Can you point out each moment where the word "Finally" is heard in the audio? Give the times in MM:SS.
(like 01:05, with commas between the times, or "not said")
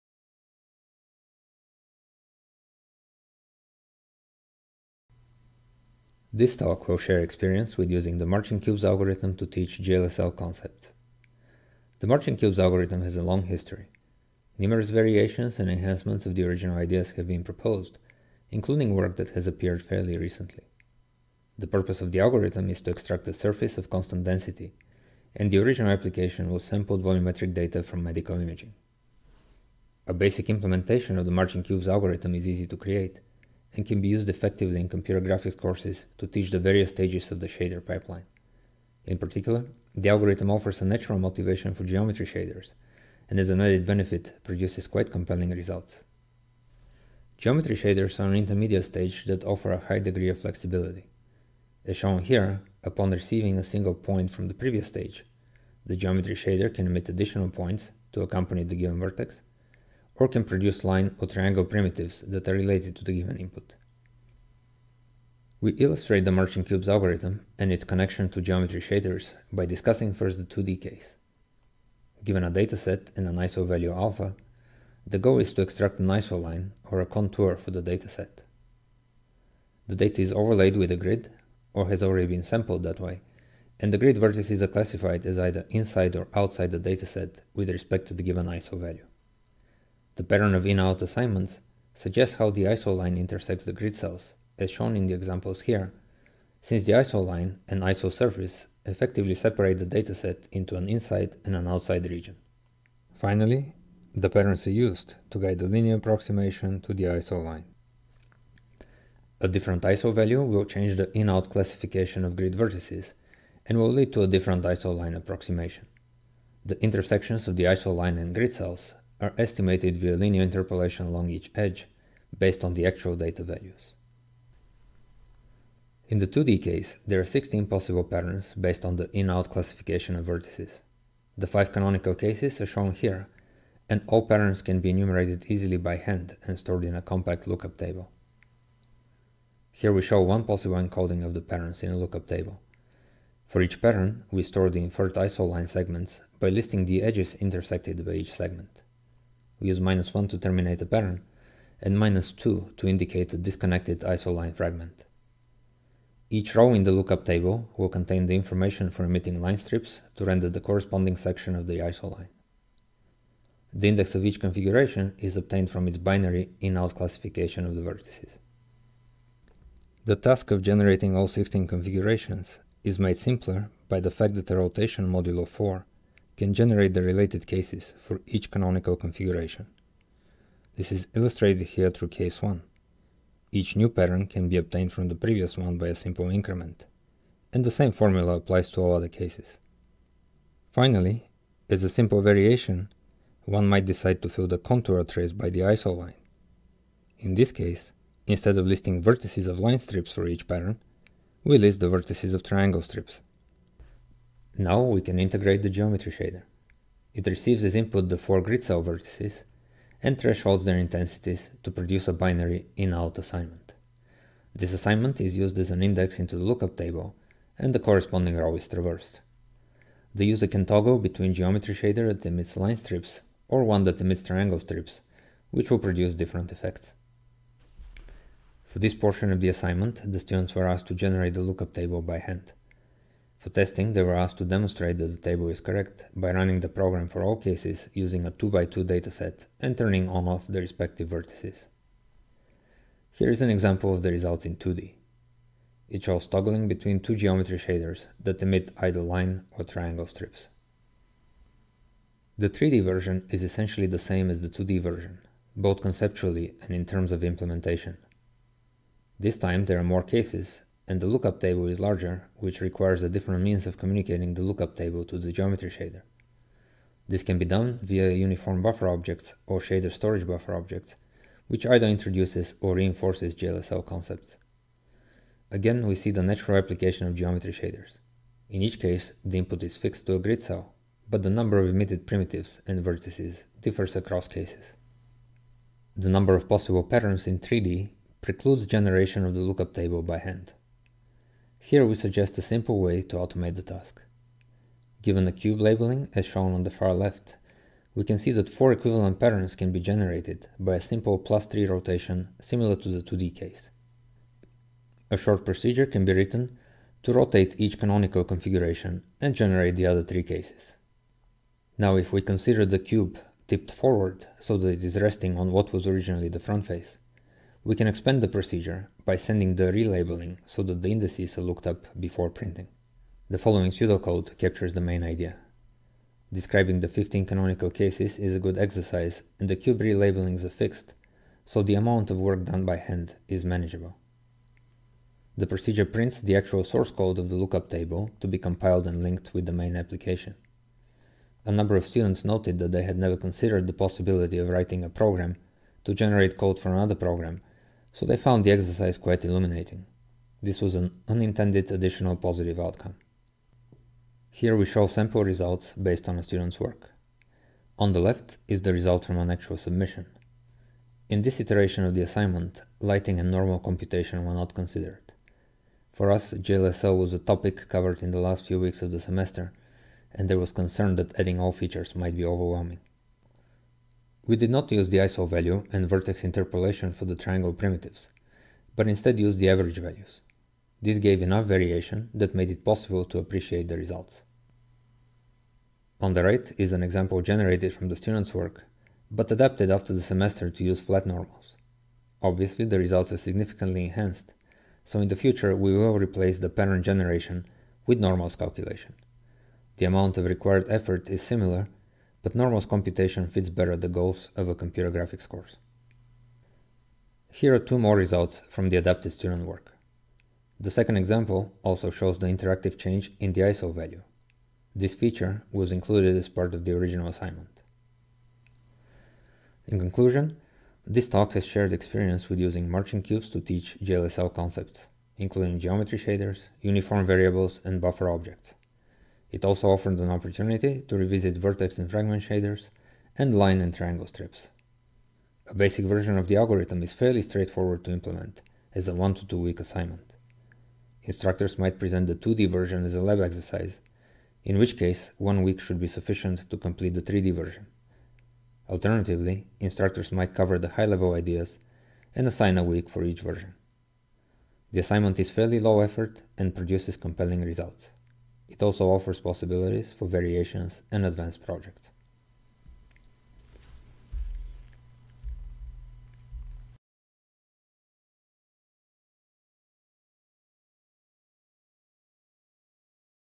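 01:43, 03:10.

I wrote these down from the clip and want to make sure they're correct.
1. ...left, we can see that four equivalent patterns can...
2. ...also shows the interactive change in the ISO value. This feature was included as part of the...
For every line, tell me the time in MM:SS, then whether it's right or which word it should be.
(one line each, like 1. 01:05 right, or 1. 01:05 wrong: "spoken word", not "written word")
1. 04:56 right
2. 06:51 right.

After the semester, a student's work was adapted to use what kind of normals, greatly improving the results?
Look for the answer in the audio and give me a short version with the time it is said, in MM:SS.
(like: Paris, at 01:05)
flat normals, at 06:30.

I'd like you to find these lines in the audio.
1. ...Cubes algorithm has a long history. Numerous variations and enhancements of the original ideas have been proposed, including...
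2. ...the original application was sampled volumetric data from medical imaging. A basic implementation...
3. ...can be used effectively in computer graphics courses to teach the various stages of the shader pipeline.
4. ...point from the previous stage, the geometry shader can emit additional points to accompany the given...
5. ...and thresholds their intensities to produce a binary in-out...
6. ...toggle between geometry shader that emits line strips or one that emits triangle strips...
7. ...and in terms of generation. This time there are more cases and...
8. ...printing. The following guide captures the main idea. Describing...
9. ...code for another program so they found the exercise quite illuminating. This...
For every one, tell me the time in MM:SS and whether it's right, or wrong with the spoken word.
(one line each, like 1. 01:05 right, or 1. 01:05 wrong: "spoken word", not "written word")
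1. 00:12 right
2. 00:25 right
3. 00:33 right
4. 00:53 right
5. 03:30 right
6. 03:40 right
7. 04:16 wrong: "implementation", not "generation"
8. 05:22 wrong: "pseudocode", not "guide"
9. 05:46 right.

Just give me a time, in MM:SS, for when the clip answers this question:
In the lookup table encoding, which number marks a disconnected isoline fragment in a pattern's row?
02:31.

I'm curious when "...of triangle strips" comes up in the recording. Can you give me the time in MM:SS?
03:22.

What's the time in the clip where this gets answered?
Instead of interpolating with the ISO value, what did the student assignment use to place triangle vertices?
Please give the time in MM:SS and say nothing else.
06:19.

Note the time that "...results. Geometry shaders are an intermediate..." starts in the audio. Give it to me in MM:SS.
00:45.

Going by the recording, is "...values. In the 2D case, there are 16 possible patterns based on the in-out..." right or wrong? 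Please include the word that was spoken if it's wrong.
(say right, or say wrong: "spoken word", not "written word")
right.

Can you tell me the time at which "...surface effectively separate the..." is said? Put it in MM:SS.
01:38.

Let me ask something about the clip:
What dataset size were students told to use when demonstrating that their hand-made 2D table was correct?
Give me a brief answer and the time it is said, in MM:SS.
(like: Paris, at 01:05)
2x2, at 03:58.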